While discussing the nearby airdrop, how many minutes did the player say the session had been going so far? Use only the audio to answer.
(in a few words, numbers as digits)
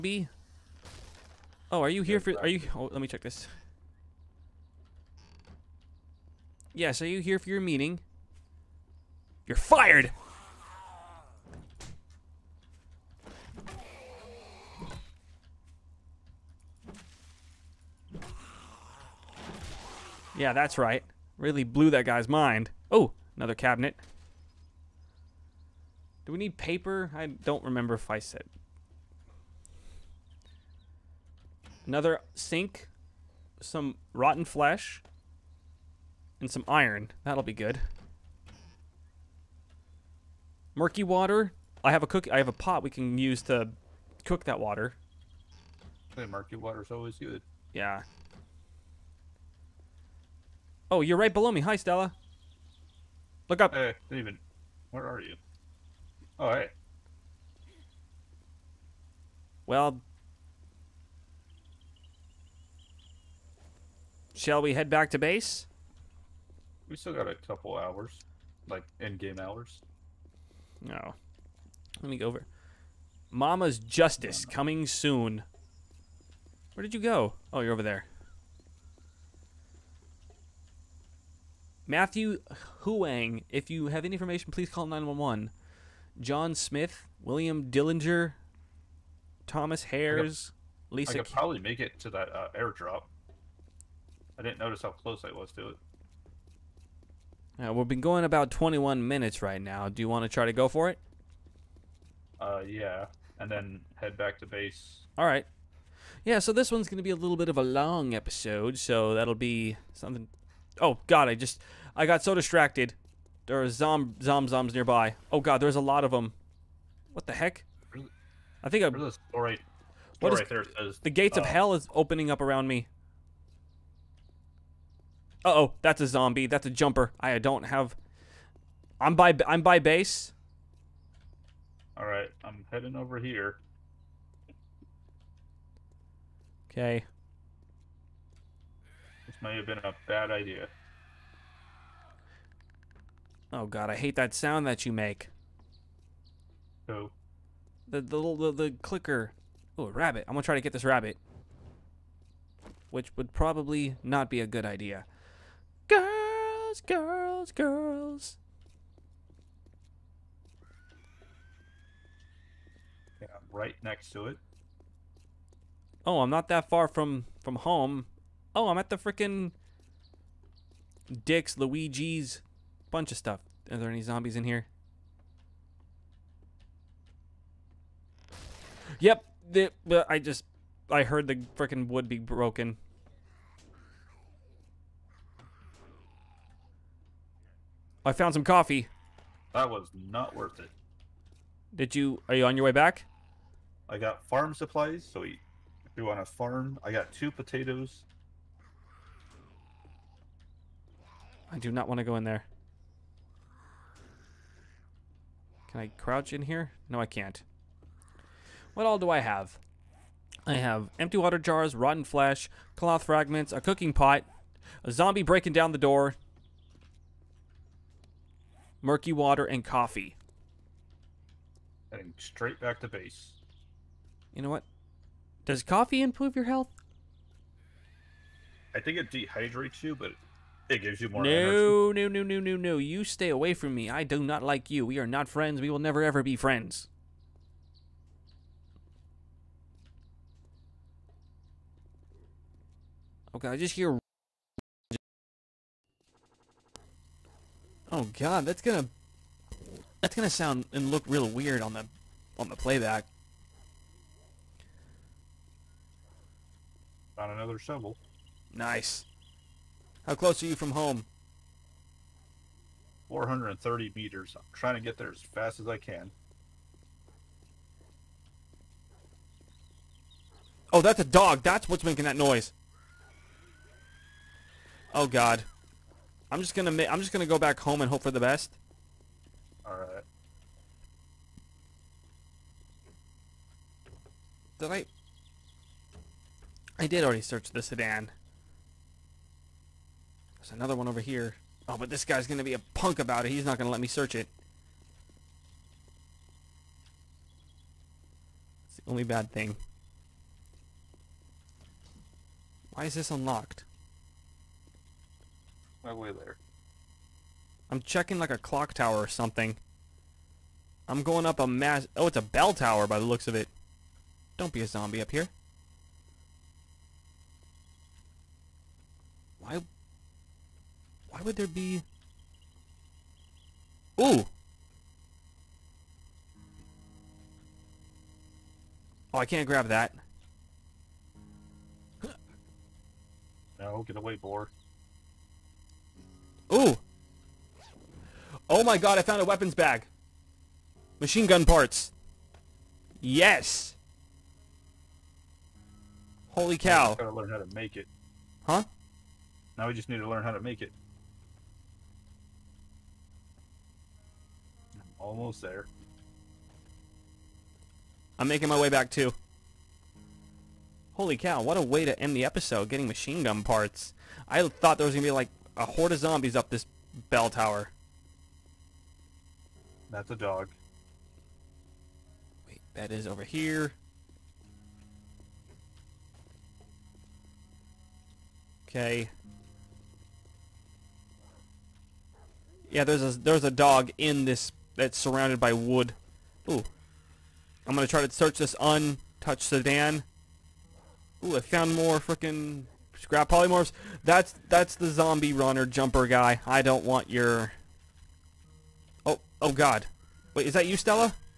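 21 minutes.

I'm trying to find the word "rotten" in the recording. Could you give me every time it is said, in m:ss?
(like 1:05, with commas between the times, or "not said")
0:34, 3:31.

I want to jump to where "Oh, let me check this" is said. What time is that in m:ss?
0:02.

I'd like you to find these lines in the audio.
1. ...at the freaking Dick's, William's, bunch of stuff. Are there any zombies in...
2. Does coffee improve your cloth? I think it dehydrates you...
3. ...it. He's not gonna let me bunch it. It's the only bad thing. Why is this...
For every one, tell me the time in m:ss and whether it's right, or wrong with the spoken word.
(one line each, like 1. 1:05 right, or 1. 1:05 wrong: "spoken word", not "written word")
1. 2:48 wrong: "Luigi", not "William"
2. 3:45 wrong: "health", not "cloth"
3. 4:53 wrong: "search", not "bunch".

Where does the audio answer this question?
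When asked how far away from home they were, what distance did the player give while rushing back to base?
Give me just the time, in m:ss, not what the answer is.
4:23.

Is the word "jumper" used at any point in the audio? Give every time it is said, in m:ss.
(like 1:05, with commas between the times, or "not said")
2:06, 6:35.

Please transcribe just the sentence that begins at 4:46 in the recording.
I did already search the sedan.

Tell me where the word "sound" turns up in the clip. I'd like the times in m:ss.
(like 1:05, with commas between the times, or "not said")
2:24, 4:10.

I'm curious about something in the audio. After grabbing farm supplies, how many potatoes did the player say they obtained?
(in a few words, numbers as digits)
2.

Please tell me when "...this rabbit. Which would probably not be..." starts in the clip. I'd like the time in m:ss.
2:30.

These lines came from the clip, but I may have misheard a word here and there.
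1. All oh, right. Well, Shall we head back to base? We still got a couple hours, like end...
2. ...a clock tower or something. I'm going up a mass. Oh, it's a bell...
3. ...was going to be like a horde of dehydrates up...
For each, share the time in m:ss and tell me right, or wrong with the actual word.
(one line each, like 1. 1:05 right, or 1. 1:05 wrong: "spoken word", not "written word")
1. 0:56 right
2. 5:08 right
3. 6:04 wrong: "zombies", not "dehydrates".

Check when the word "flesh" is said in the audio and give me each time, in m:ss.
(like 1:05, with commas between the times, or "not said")
0:34, 3:32.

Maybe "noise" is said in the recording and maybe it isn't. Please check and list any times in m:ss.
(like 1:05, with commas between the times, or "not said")
4:32.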